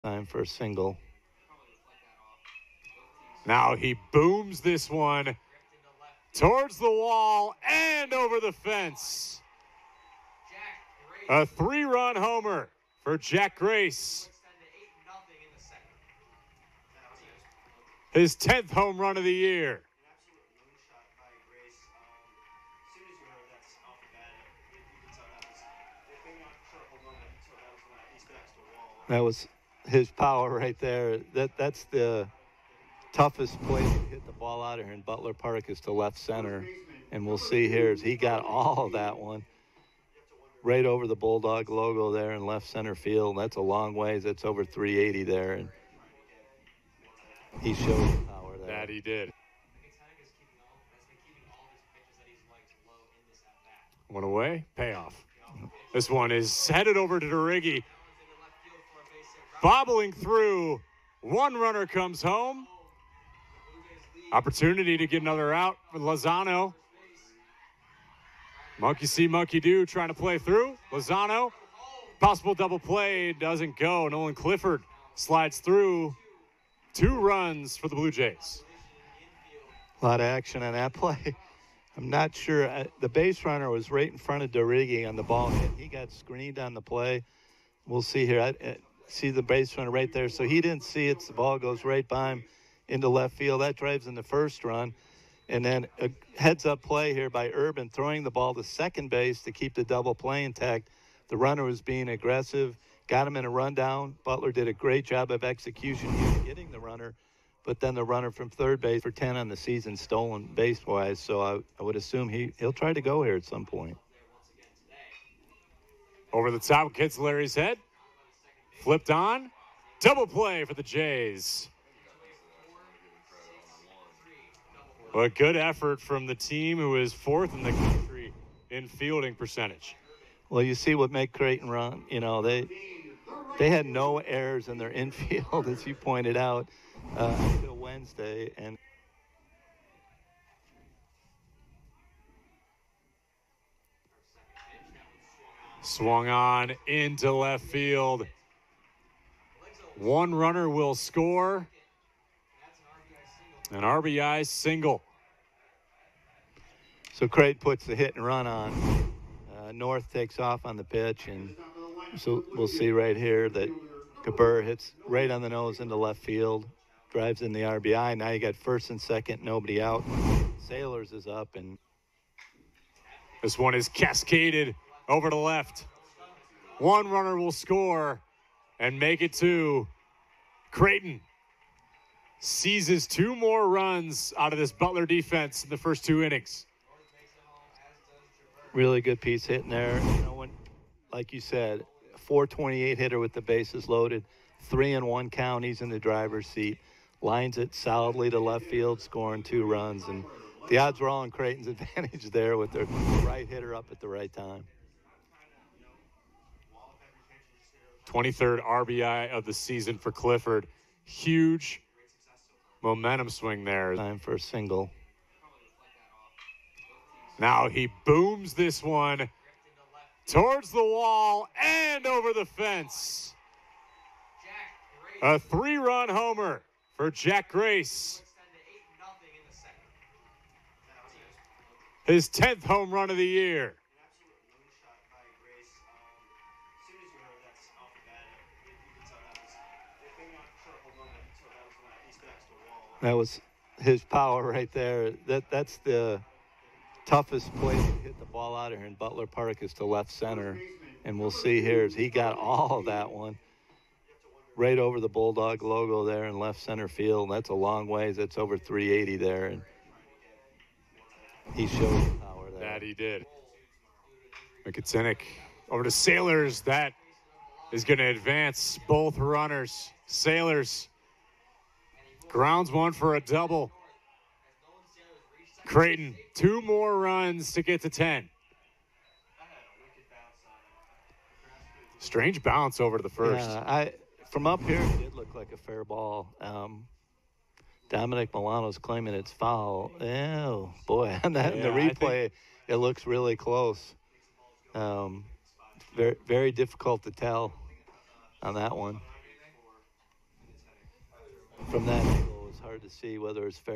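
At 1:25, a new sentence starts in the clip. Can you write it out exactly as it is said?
He got screened on the play.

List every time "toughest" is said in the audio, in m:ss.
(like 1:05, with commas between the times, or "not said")
0:33, 4:07.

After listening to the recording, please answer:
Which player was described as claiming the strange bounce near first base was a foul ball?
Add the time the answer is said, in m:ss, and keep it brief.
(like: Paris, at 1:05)
Dominic Milano, at 4:47.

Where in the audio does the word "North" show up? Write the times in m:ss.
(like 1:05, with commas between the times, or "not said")
2:39.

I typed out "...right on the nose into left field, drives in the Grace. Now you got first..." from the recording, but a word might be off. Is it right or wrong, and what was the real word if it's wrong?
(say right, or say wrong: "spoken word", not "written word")
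wrong: "RBI", not "Grace".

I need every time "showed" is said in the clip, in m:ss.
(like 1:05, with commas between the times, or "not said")
0:47, 4:21.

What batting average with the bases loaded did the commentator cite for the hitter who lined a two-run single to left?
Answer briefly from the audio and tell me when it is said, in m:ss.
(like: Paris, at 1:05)
.428, at 3:12.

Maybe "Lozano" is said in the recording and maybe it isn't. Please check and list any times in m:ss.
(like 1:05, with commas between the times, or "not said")
1:05, 1:10.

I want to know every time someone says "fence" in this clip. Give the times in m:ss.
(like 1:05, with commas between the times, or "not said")
0:08, 3:42.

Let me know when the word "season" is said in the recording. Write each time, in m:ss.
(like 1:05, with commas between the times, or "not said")
1:49, 3:29.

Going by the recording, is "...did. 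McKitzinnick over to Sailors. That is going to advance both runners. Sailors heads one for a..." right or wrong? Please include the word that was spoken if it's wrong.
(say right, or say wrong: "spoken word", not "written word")
wrong: "grounds", not "heads".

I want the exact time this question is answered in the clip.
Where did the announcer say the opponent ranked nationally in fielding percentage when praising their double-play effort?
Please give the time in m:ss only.
2:07.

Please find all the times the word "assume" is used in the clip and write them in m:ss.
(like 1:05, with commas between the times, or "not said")
1:51.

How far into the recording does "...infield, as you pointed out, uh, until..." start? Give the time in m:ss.
2:14.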